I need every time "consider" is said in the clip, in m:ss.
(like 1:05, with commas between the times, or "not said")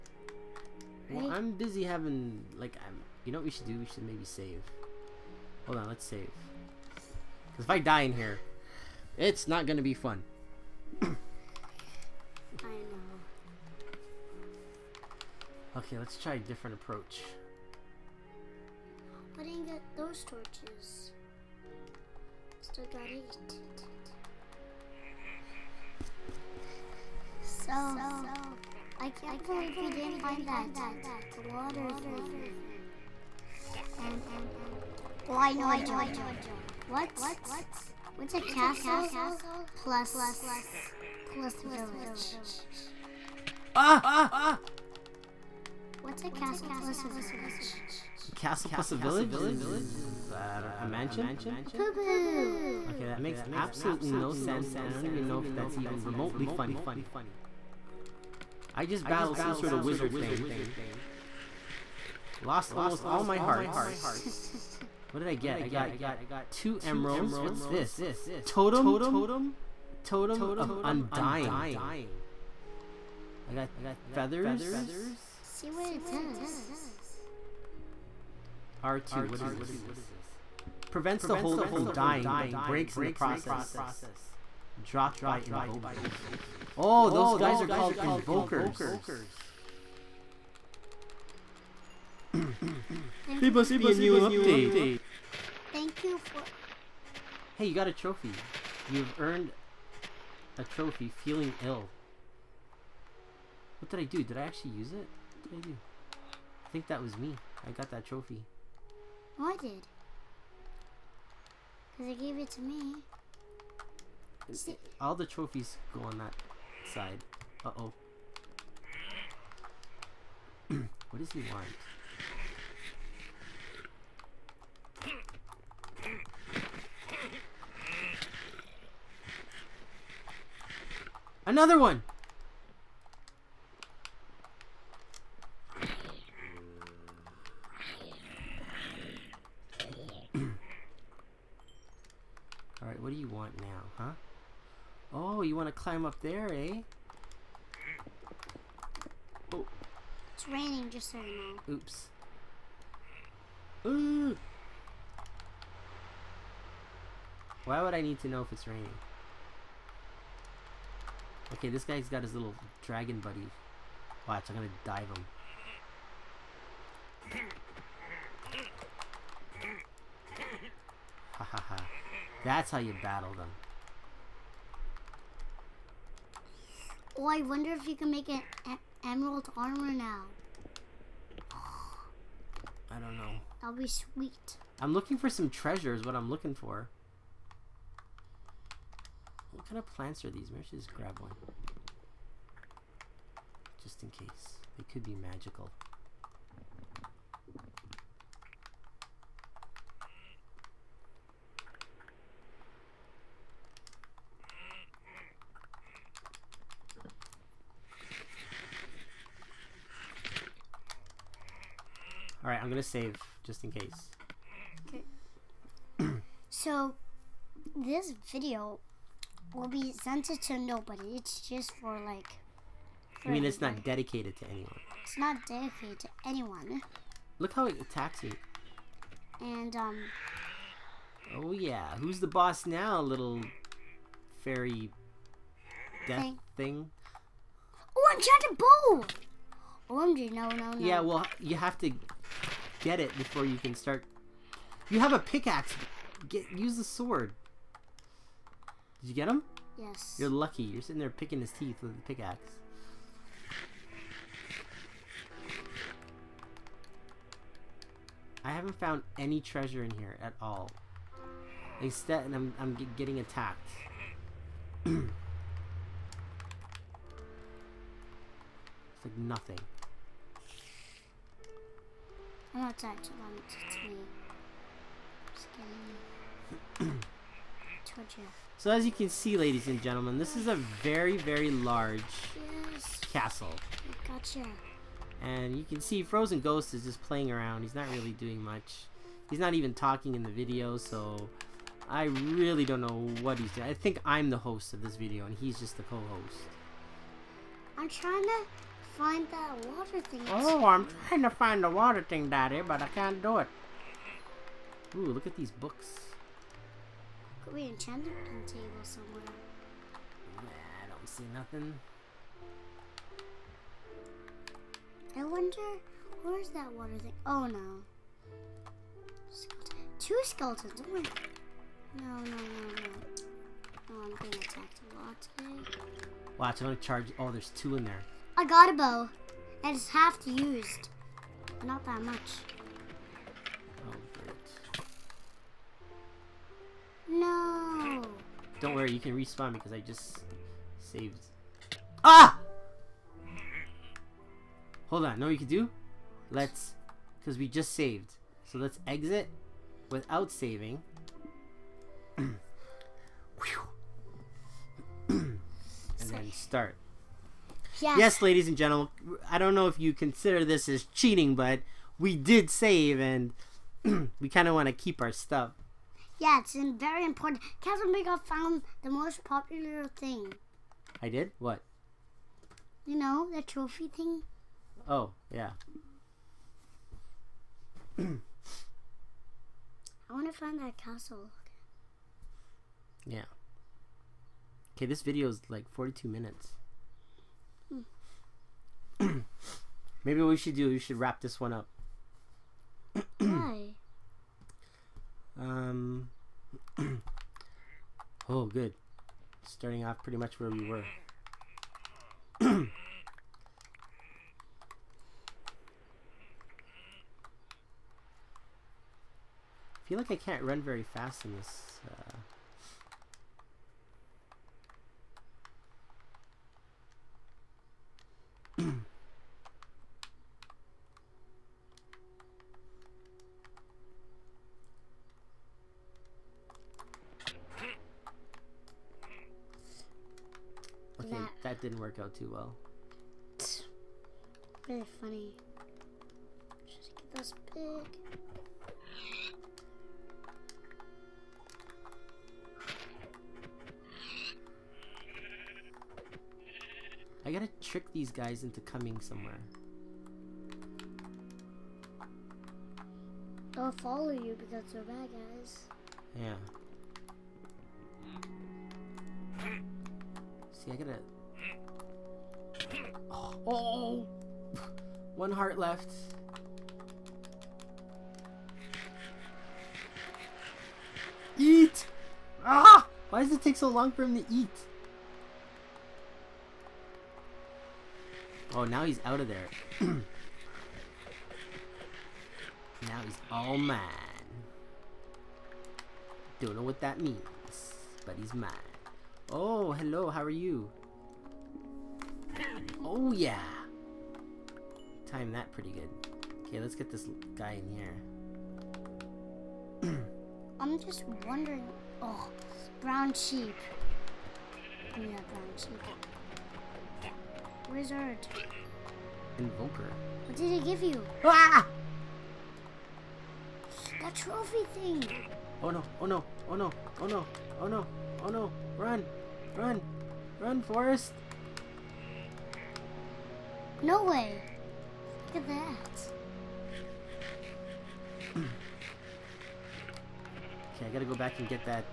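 5:59.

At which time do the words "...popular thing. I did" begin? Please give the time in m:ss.
6:09.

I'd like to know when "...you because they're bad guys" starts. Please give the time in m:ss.
7:34.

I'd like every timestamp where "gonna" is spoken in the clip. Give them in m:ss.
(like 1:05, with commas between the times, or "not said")
2:44, 3:32, 5:26.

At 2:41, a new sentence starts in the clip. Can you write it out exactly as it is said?
Okay, this guy's got his little dragon buddy.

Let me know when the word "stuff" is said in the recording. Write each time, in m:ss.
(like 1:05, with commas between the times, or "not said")
6:05.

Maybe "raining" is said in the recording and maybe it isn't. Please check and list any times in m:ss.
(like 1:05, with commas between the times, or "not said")
2:30, 2:38.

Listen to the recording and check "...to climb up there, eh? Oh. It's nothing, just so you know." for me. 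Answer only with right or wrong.
wrong.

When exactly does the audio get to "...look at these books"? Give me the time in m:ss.
5:05.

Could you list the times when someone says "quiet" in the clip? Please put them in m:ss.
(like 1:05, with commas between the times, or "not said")
not said.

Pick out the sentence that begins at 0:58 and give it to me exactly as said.
I just battled some sort of wizard thing.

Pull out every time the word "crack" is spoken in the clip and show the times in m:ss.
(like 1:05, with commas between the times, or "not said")
not said.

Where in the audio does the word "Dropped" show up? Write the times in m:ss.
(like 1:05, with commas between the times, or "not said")
1:24.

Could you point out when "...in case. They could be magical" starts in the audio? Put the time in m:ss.
3:14.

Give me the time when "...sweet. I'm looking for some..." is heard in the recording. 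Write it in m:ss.
3:03.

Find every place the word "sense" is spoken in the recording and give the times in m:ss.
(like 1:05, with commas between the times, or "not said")
0:54.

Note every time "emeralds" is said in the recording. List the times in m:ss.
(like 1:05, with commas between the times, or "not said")
1:06, 2:59.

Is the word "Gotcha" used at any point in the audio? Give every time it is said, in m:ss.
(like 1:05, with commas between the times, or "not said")
4:44.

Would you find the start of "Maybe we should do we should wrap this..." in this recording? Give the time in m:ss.
6:30.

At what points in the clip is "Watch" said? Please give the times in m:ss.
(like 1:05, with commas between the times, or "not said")
2:44, 5:26.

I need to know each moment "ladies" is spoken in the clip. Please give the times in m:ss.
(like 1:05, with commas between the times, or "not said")
4:39, 5:58.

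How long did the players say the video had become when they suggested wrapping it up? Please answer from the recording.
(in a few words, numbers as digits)
42 minutes.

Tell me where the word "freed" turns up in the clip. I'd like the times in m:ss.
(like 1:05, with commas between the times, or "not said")
not said.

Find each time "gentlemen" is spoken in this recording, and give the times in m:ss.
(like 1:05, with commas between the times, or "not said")
4:39, 5:58.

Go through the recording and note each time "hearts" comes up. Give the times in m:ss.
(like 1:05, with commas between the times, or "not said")
1:03, 7:45.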